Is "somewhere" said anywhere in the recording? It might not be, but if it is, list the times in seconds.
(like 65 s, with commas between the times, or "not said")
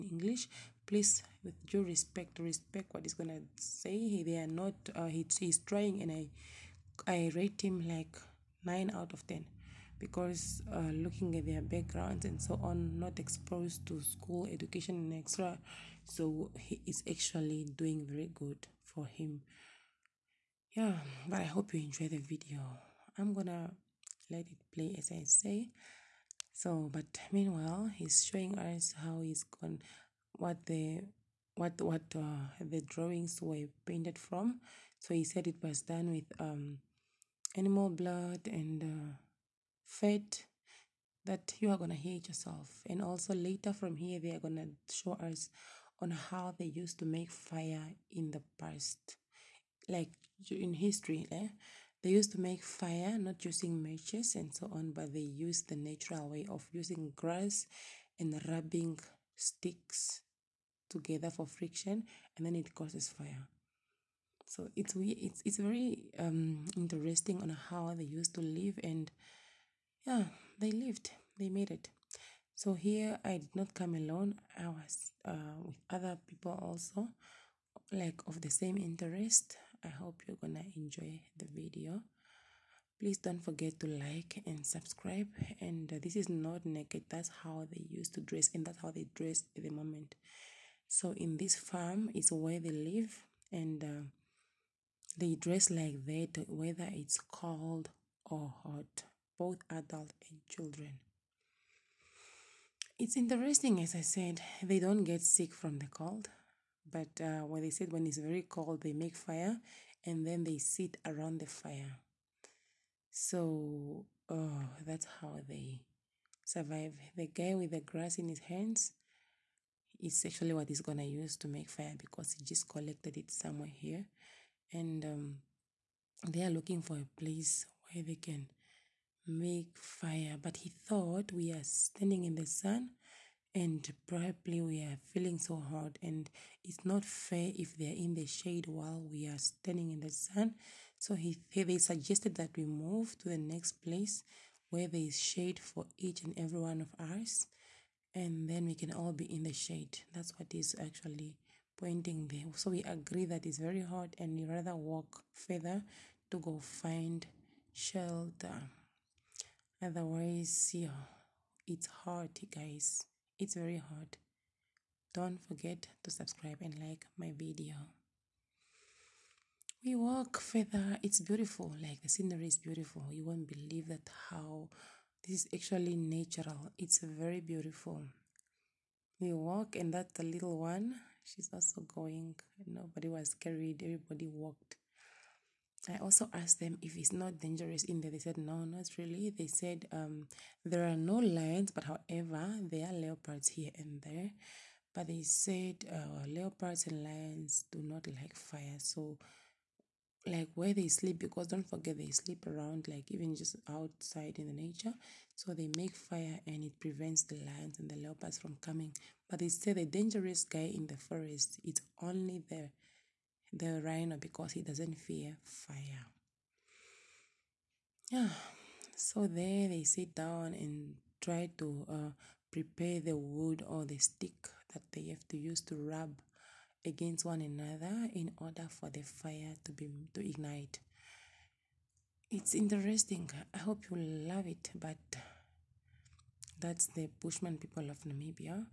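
123 s.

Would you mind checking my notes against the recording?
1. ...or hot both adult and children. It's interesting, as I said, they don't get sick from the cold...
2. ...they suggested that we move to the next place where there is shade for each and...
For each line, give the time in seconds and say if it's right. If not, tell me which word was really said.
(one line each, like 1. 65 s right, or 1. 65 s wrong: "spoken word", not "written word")
1. 98 s right
2. 141 s right.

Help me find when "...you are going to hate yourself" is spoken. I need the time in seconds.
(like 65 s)
41 s.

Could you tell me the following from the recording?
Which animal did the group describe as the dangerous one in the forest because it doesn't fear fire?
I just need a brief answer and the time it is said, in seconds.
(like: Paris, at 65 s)
Rhino, at 213 s.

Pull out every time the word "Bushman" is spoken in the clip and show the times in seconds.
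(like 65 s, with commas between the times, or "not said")
237 s.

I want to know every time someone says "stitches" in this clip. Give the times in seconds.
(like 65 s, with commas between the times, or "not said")
not said.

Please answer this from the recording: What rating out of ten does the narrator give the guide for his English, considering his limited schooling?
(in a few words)
9 out of 10.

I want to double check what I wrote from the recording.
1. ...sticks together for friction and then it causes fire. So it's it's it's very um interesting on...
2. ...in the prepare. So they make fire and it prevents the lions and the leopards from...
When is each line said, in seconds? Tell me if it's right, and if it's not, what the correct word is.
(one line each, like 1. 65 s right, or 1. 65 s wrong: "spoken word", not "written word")
1. 59 s right
2. 204 s wrong: "nature", not "prepare".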